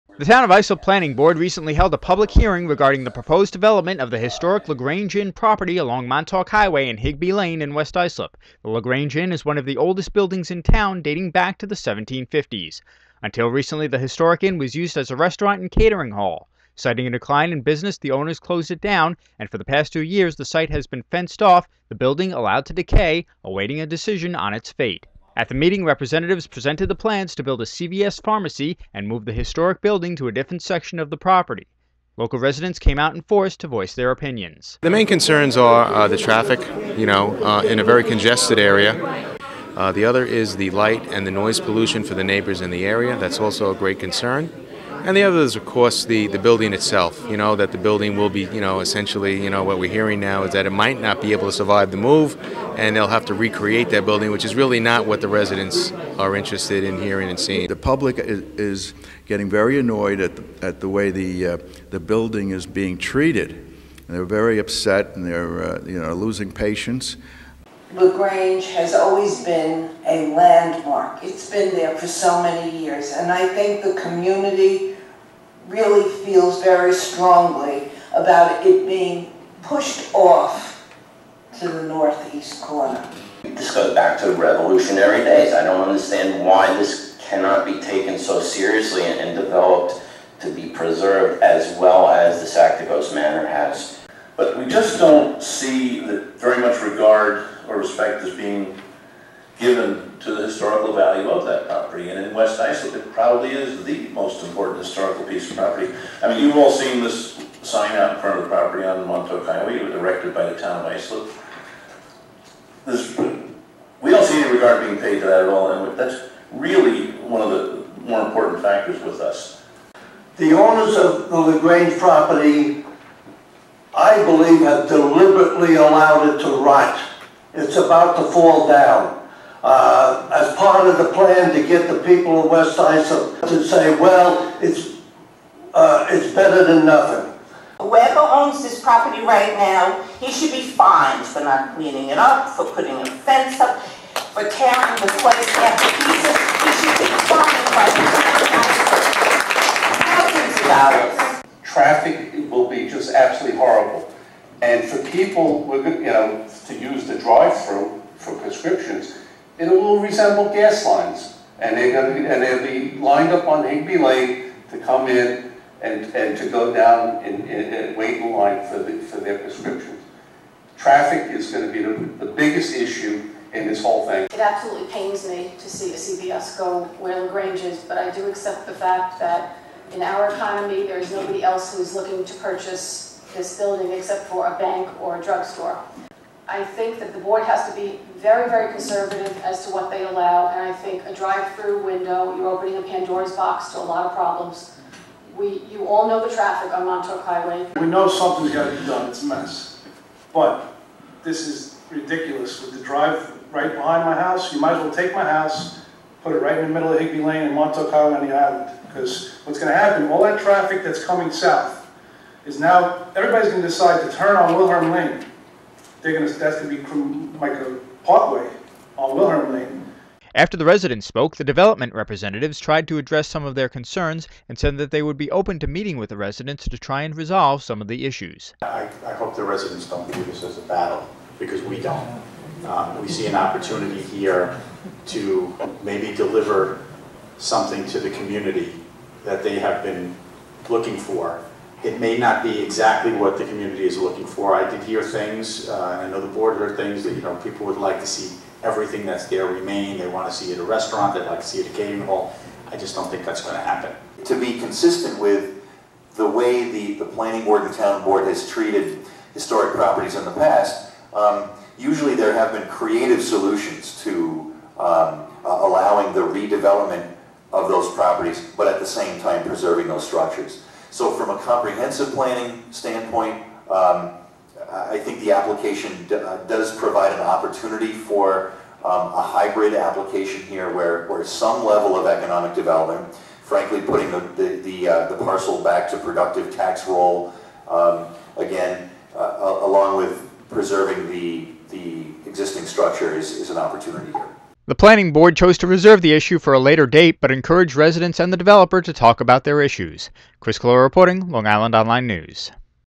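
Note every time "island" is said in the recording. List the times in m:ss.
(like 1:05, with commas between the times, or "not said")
3:28, 5:01.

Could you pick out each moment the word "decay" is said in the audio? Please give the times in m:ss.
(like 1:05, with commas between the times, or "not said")
0:22.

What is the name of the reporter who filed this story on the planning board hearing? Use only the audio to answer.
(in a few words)
Chris Collora.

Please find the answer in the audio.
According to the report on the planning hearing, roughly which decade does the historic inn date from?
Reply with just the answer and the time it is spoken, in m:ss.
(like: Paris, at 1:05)
1750s, at 0:11.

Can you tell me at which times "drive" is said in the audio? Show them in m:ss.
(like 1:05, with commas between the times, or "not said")
2:37, 3:11, 3:22.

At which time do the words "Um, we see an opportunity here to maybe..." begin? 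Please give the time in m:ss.
3:52.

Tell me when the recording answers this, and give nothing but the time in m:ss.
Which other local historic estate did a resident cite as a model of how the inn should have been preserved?
1:32.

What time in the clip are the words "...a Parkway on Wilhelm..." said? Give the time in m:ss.
3:37.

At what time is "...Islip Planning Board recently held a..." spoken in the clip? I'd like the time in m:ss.
0:00.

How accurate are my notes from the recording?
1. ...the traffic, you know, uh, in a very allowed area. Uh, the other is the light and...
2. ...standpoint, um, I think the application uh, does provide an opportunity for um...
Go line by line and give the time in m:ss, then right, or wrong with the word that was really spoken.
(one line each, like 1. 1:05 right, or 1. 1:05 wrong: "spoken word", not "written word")
1. 0:36 wrong: "congested", not "allowed"
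2. 4:32 right.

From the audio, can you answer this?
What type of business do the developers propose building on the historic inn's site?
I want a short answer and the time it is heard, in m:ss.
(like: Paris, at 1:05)
CVS pharmacy, at 0:27.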